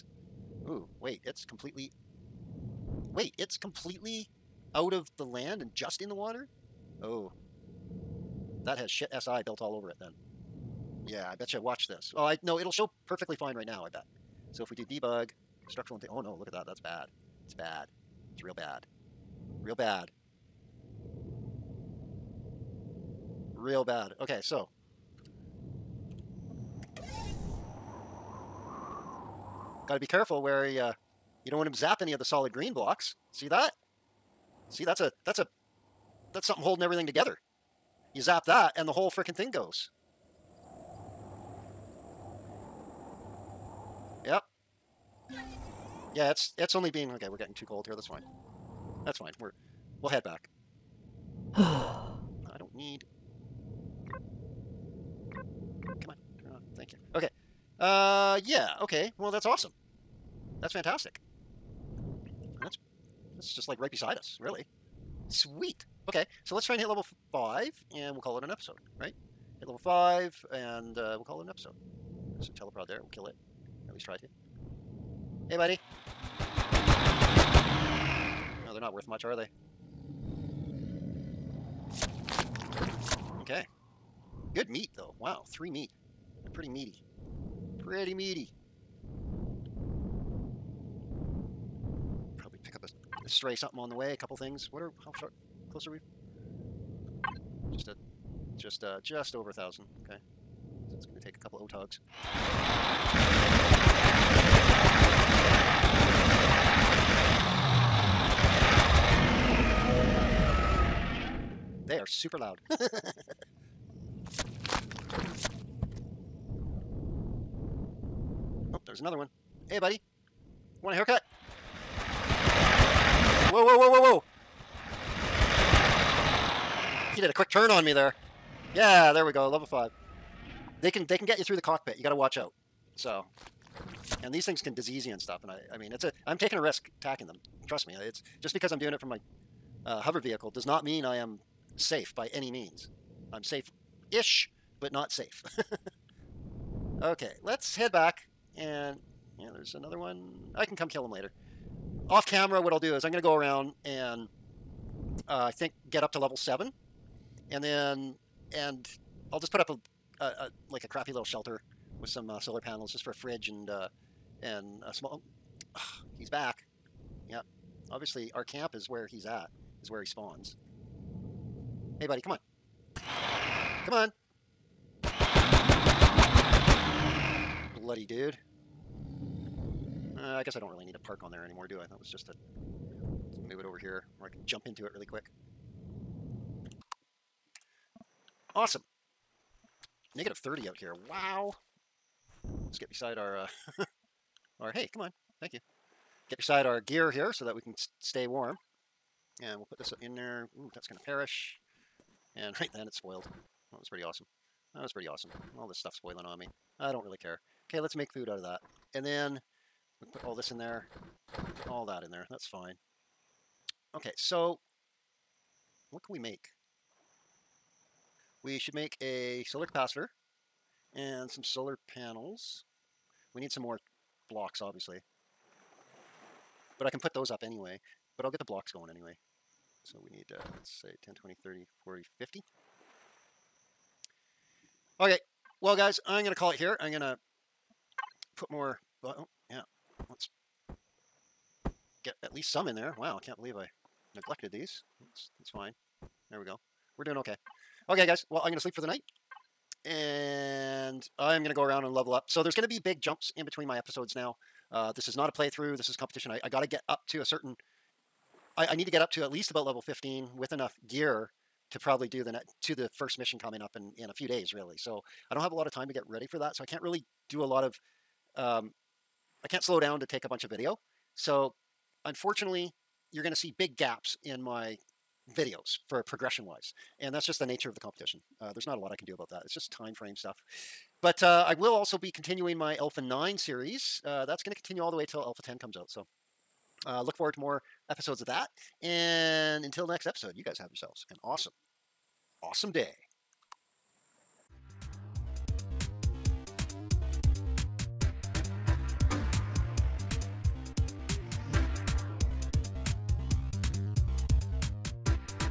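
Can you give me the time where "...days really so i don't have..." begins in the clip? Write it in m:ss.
4:24.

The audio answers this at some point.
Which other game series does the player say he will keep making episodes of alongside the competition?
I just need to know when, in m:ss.
4:42.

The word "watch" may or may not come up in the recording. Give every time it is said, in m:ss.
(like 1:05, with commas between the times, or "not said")
0:11, 2:12.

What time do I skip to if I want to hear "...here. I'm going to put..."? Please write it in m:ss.
3:56.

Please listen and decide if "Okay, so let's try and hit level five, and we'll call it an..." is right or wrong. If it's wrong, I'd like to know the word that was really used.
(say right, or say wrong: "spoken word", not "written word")
right.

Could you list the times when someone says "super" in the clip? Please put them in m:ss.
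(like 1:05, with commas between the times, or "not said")
1:52.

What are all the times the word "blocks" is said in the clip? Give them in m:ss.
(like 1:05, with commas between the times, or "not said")
0:32, 3:44, 3:48.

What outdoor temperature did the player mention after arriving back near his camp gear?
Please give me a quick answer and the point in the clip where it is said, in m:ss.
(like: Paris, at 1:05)
-30, at 3:10.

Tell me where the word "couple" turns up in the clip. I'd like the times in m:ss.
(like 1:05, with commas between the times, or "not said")
1:34, 1:41.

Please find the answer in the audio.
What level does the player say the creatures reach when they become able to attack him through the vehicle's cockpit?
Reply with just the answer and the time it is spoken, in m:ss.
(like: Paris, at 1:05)
Level 5, at 2:09.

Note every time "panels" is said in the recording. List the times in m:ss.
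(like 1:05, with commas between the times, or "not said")
2:42, 3:41.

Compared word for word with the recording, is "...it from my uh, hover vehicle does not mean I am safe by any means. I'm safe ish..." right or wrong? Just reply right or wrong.
right.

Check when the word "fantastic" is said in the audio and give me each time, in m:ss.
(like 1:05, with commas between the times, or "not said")
1:00.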